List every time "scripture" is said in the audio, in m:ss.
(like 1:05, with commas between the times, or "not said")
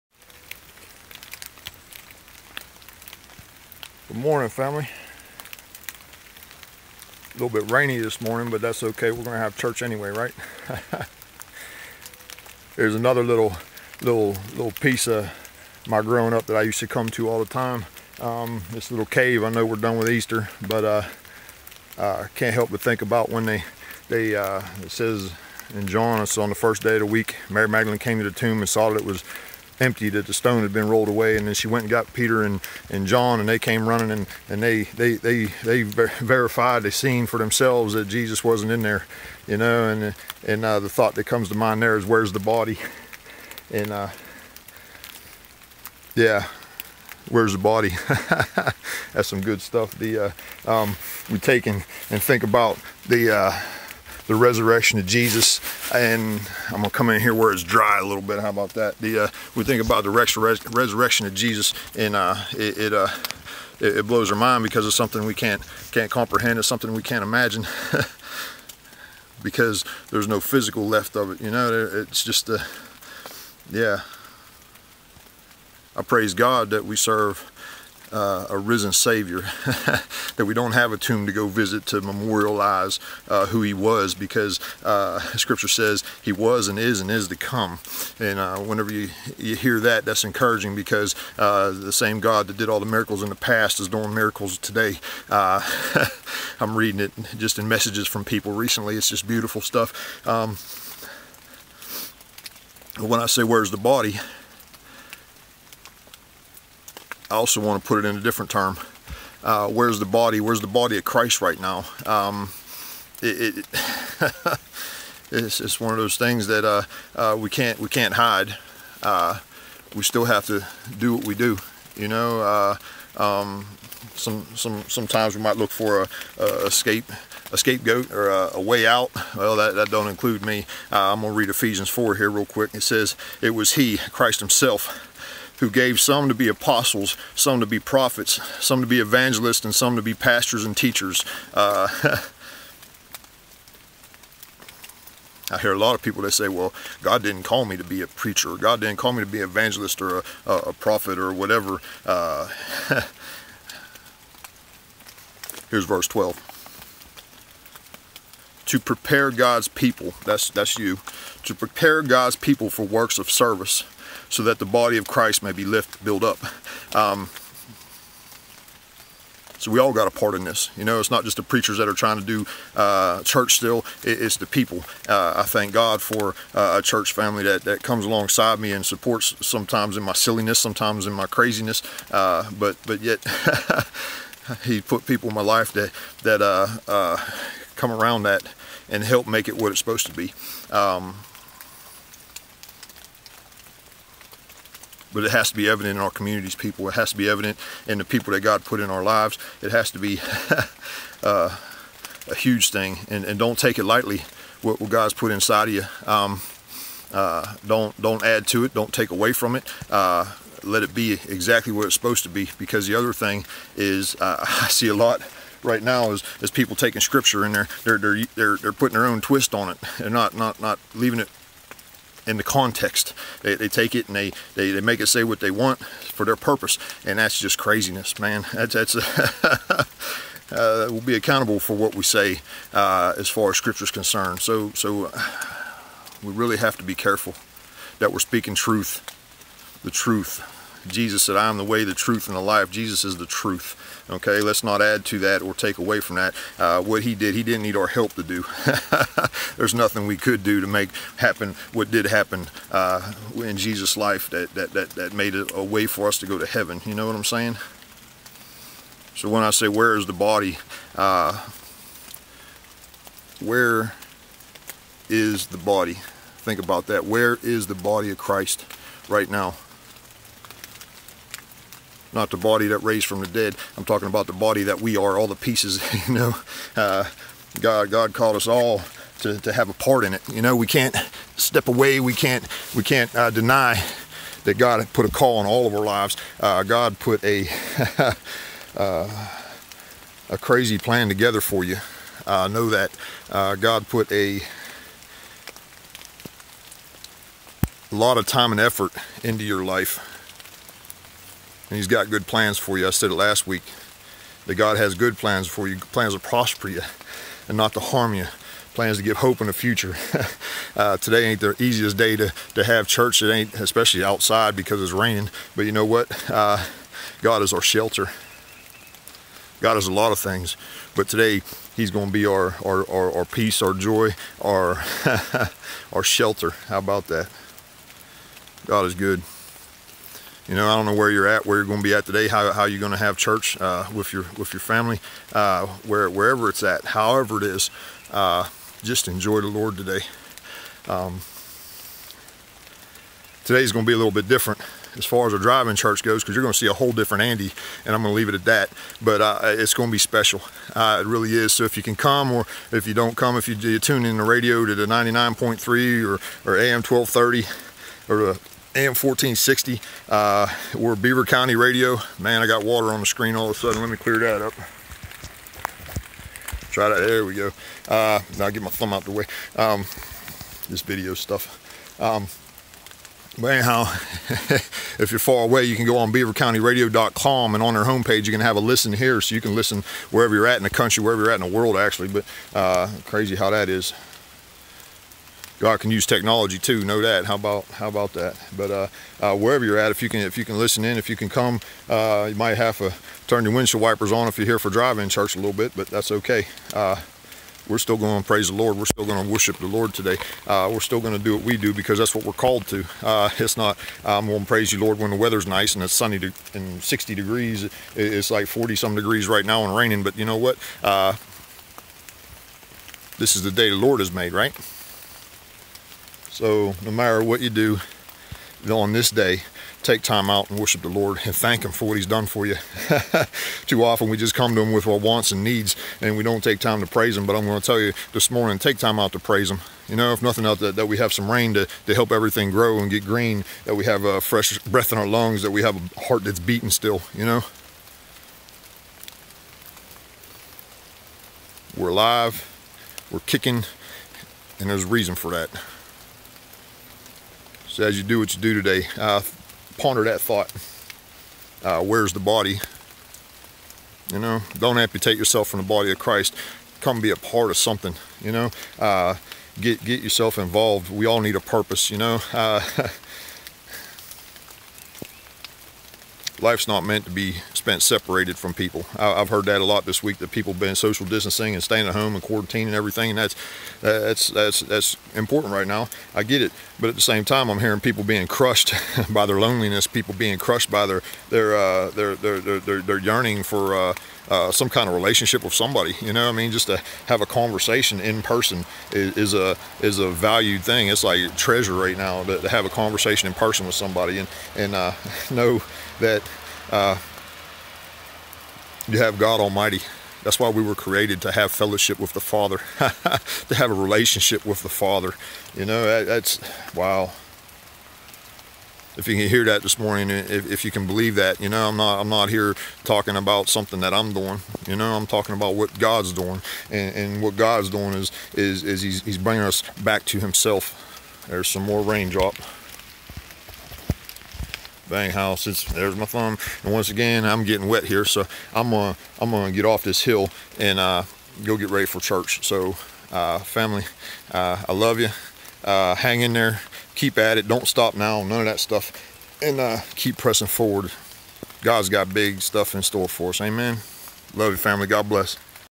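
1:25, 3:37, 3:53.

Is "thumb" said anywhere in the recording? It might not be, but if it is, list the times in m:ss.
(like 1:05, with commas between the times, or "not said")
6:08, 8:46.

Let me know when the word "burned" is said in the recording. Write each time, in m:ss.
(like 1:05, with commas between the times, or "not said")
not said.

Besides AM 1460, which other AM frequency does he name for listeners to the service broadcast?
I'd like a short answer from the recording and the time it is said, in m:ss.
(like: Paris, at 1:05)
AM 1230, at 5:56.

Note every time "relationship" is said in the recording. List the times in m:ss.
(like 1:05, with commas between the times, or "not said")
8:04, 8:23.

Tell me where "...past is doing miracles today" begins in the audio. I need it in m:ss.
1:33.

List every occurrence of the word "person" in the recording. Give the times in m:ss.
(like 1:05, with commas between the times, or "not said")
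8:08, 8:13.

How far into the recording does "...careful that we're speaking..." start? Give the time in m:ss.
3:56.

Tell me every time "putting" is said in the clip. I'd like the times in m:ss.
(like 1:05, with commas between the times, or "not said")
3:38.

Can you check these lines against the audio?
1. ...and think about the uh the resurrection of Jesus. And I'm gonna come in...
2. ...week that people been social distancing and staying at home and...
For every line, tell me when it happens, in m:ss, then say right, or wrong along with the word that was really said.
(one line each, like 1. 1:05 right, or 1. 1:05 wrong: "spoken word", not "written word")
1. 0:52 right
2. 7:50 right.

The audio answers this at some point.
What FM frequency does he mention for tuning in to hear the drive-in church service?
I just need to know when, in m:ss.
5:54.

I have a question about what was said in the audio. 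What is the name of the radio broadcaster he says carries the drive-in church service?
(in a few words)
Beaver County Radio.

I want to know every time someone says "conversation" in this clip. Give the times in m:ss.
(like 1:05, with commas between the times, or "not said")
8:07, 8:12.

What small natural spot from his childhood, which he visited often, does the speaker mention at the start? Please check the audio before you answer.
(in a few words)
cave.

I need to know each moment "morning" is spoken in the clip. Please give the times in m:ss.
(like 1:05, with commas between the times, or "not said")
0:04, 0:08, 7:08, 8:29.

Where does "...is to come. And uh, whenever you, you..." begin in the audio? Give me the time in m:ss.
1:27.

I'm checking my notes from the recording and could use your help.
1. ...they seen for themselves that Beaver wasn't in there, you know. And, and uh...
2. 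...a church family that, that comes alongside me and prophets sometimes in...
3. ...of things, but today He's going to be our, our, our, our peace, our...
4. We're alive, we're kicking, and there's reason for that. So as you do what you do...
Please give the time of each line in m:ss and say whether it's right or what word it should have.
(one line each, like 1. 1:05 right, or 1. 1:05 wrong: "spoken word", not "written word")
1. 0:36 wrong: "Jesus", not "Beaver"
2. 2:56 wrong: "supports", not "prophets"
3. 5:20 right
4. 7:21 right.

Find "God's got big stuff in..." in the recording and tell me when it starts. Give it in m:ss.
9:01.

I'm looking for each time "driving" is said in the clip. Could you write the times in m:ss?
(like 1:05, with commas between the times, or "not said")
5:45, 6:34.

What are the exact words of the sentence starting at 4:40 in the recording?
You know, we can't step away.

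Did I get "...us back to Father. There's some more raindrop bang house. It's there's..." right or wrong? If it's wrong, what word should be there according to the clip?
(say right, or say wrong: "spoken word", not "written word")
wrong: "Himself", not "Father".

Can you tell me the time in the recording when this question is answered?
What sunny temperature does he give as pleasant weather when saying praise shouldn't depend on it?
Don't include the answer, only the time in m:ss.
6:46.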